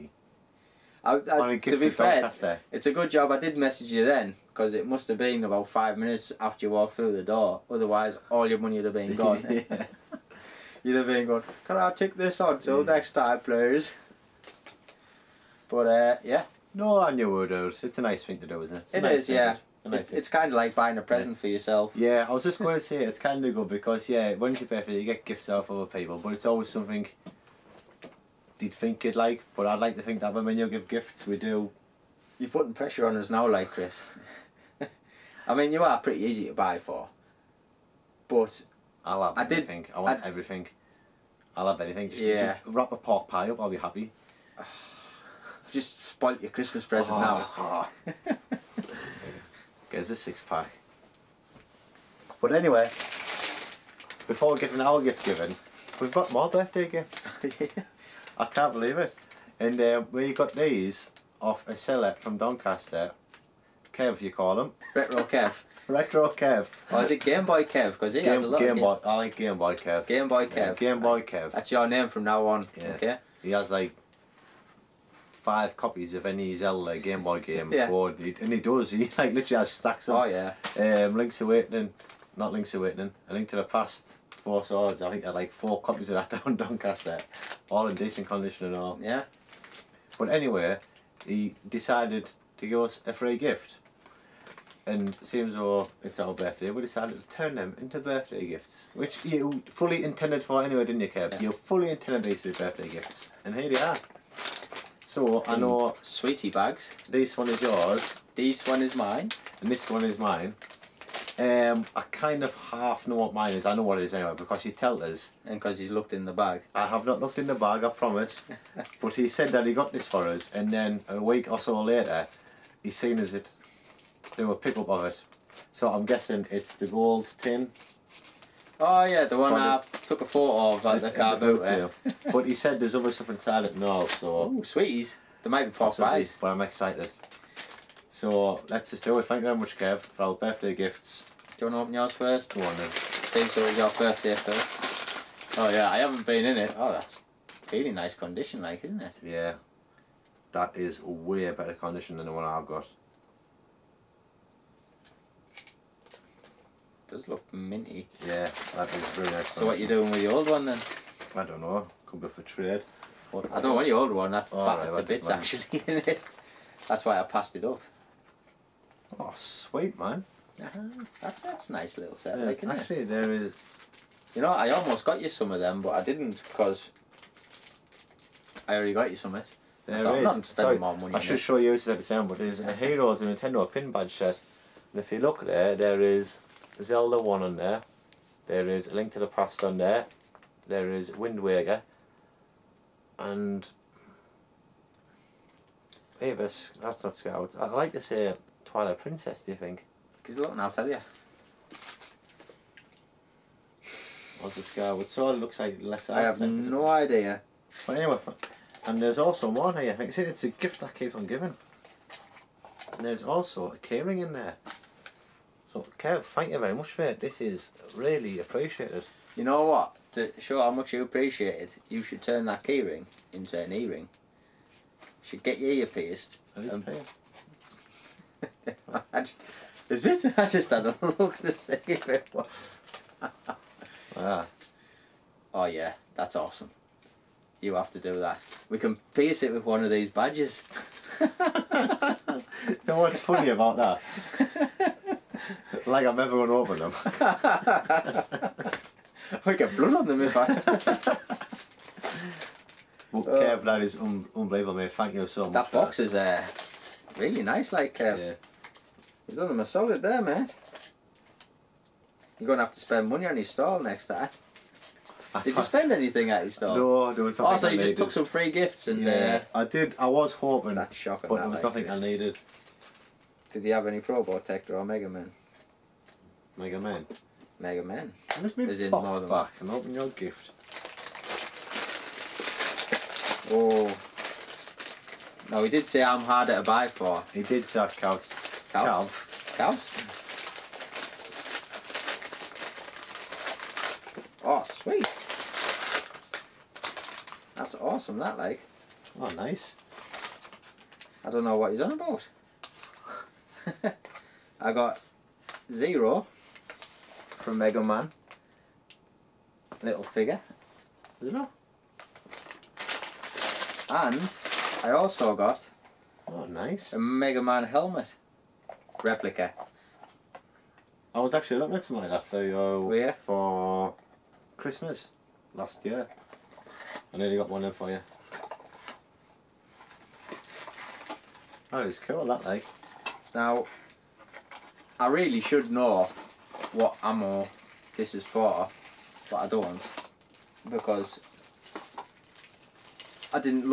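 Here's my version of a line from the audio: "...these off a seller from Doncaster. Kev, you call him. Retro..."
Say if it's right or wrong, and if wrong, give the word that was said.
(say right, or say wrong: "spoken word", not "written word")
right.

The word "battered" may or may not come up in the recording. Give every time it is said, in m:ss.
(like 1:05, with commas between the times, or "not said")
2:44.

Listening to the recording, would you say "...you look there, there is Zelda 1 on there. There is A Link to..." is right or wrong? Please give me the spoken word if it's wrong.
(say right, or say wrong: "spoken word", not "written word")
right.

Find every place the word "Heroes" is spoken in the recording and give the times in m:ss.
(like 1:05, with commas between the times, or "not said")
3:02.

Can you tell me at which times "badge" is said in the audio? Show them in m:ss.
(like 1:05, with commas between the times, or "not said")
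3:03, 4:00.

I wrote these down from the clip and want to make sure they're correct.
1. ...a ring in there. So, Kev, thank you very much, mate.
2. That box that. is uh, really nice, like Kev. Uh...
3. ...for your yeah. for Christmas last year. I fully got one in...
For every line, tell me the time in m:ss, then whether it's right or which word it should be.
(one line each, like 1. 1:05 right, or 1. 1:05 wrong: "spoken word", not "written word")
1. 3:33 right
2. 4:15 right
3. 5:22 wrong: "nearly", not "fully".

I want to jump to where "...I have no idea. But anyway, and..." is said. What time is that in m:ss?
3:26.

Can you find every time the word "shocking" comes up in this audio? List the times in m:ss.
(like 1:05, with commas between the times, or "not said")
4:30.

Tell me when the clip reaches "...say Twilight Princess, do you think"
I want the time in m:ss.
3:18.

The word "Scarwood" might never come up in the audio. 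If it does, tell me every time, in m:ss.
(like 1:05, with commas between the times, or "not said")
3:24.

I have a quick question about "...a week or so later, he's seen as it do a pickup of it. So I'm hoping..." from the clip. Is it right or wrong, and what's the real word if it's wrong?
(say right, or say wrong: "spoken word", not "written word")
wrong: "guessing", not "hoping".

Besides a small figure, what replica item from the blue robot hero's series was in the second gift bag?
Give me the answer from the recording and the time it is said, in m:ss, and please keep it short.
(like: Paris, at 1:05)
Mega Man helmet, at 5:16.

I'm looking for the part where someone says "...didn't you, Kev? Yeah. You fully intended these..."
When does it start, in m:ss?
1:40.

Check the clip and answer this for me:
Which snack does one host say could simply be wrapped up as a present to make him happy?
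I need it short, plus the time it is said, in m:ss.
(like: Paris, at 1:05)
A pork pie, at 0:42.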